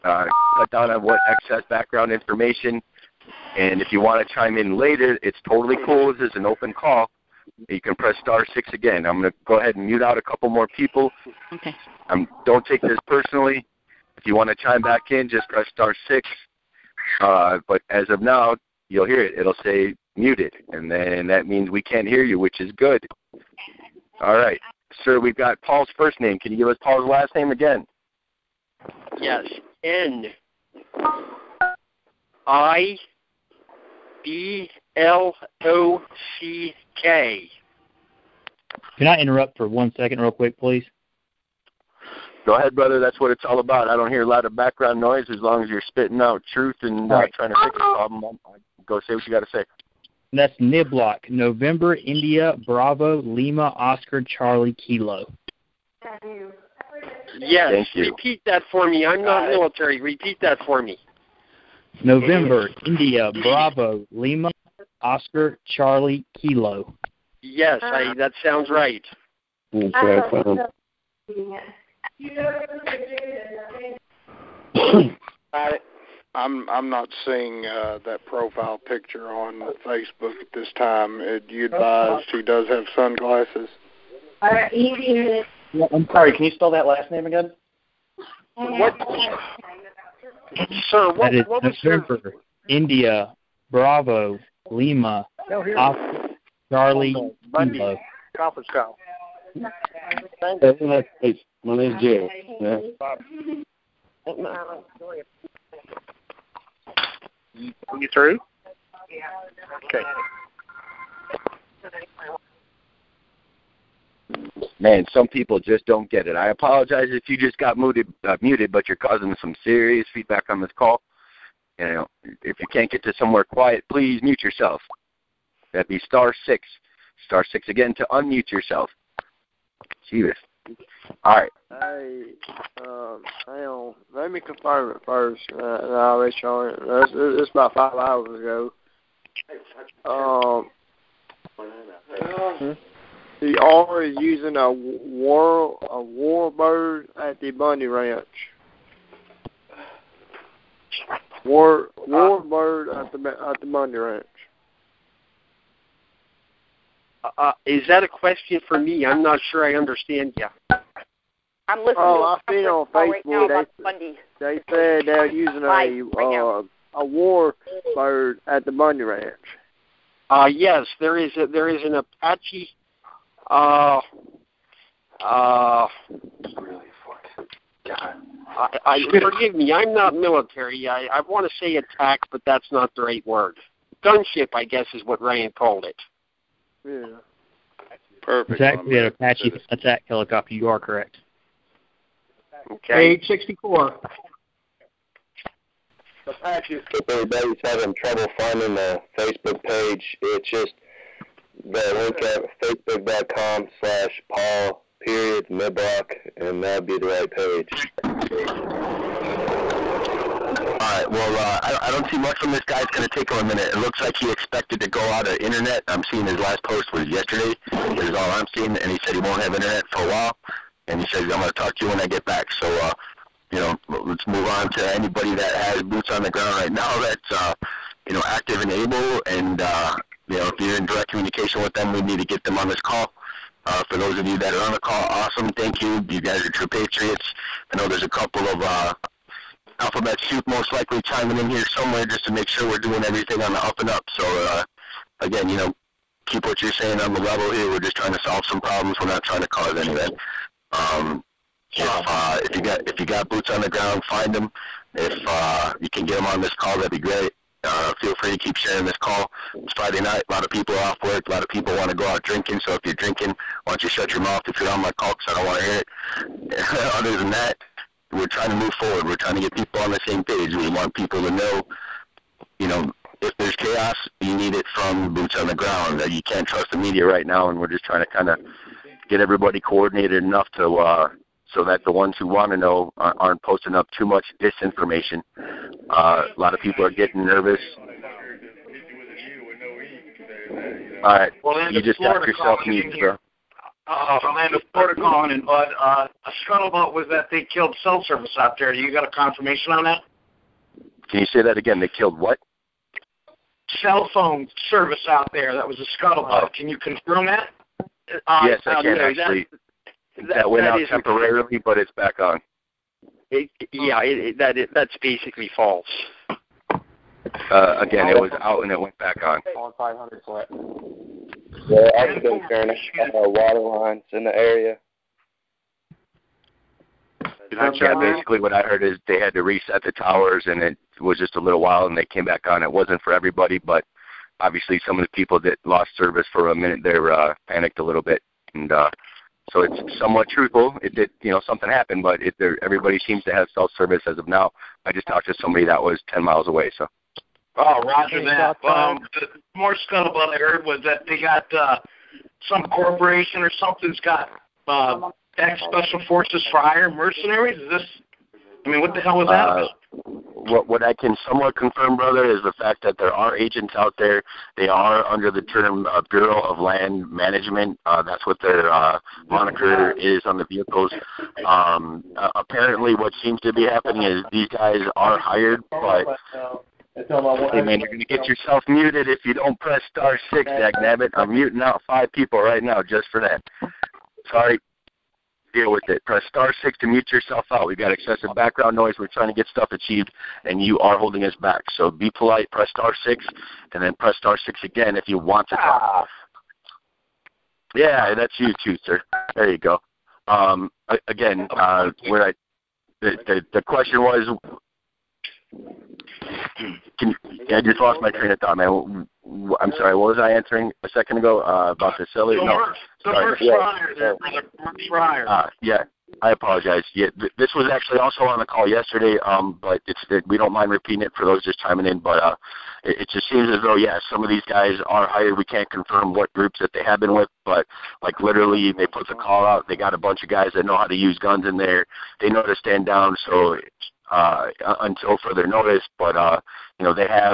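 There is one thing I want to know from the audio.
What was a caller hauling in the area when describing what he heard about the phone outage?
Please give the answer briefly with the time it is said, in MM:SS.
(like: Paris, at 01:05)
water lines, at 05:23.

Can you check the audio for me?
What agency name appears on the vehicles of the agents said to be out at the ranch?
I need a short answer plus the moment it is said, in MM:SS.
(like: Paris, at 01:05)
Bureau of Land Management, at 06:06.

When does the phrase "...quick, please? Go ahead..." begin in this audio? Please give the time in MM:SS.
00:40.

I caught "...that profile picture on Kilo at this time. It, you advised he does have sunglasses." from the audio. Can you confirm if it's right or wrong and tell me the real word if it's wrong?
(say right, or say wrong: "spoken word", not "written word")
wrong: "Facebook", not "Kilo".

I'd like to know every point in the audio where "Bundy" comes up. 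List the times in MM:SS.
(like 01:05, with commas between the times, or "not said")
01:37, 02:27, 02:33, 02:48.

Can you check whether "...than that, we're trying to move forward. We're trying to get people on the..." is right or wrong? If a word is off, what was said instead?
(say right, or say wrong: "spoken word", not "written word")
right.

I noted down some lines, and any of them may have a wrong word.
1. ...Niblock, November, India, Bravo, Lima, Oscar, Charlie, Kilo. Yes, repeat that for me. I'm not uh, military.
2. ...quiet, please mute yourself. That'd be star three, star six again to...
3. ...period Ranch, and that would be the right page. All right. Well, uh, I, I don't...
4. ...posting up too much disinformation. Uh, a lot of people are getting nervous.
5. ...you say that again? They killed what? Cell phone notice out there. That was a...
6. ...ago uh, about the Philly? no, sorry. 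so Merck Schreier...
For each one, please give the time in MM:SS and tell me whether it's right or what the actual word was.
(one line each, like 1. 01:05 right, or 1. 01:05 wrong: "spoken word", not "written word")
1. 00:50 right
2. 02:03 wrong: "six", not "three"
3. 03:25 wrong: "Niblock", not "Ranch"
4. 04:43 right
5. 05:01 wrong: "service", not "notice"
6. 06:51 right.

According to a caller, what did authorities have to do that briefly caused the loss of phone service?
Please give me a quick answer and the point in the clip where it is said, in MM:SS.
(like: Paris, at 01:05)
reset the towers, at 05:29.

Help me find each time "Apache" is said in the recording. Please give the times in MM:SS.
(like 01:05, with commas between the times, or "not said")
02:51, 03:09.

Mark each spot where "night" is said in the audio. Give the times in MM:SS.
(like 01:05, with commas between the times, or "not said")
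04:19.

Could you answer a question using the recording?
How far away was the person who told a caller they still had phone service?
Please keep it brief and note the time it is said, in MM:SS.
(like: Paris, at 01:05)
10 miles, at 05:46.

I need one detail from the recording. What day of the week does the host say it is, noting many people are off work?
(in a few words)
Friday.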